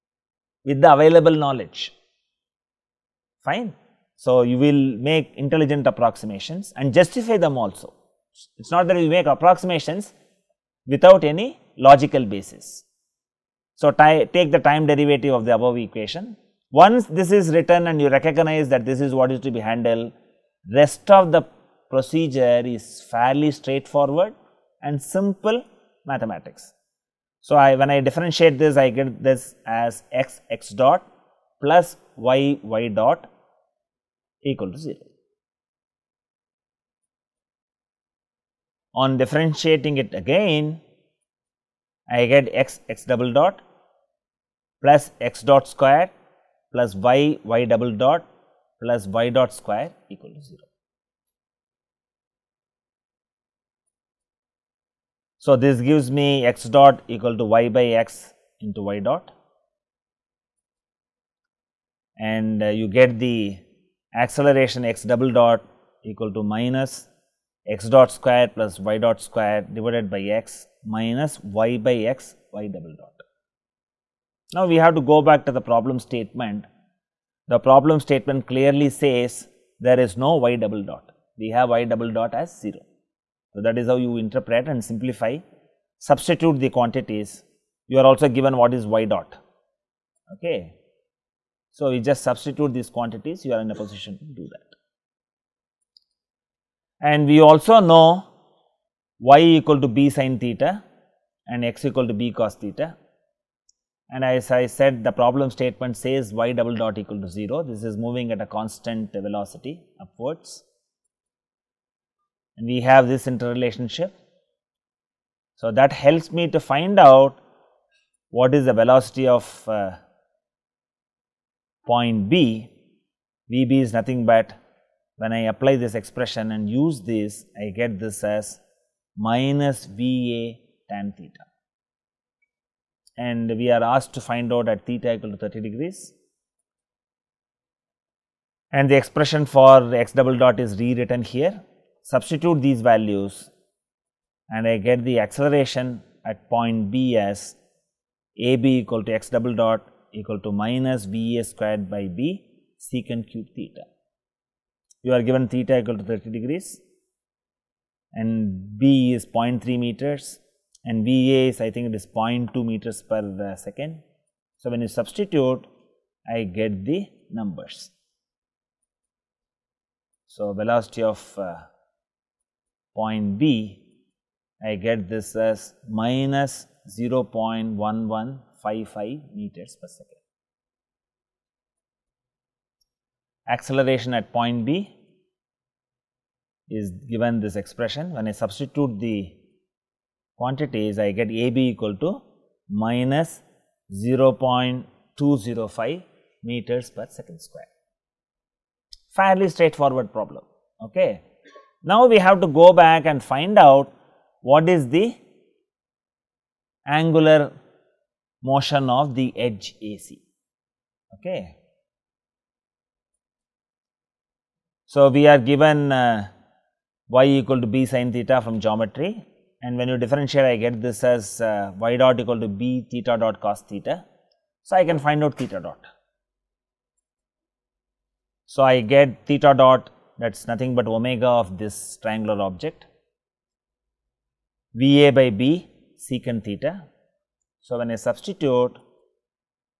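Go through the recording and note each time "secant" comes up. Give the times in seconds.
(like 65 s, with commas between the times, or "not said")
152 s, 236 s.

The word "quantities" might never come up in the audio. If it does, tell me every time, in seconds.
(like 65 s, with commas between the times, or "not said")
86 s, 92 s, 190 s.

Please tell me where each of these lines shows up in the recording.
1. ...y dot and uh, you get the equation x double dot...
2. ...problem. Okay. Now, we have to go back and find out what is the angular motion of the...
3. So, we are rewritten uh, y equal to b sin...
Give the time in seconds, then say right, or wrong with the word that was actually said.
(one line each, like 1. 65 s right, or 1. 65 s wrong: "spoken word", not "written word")
1. 58 s wrong: "acceleration", not "equation"
2. 200 s right
3. 214 s wrong: "given", not "rewritten".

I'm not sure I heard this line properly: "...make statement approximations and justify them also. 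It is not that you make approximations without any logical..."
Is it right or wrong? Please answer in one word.
wrong.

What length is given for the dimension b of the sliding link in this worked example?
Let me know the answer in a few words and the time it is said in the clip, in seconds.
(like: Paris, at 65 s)
0.3 meters, at 159 s.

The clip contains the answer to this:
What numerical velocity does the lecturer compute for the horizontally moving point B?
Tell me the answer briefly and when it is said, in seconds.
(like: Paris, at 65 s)
-0.1155 m/s, at 175 s.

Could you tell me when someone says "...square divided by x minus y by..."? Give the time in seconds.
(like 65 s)
69 s.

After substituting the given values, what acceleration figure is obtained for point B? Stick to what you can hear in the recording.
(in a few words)
-0.205 m/s².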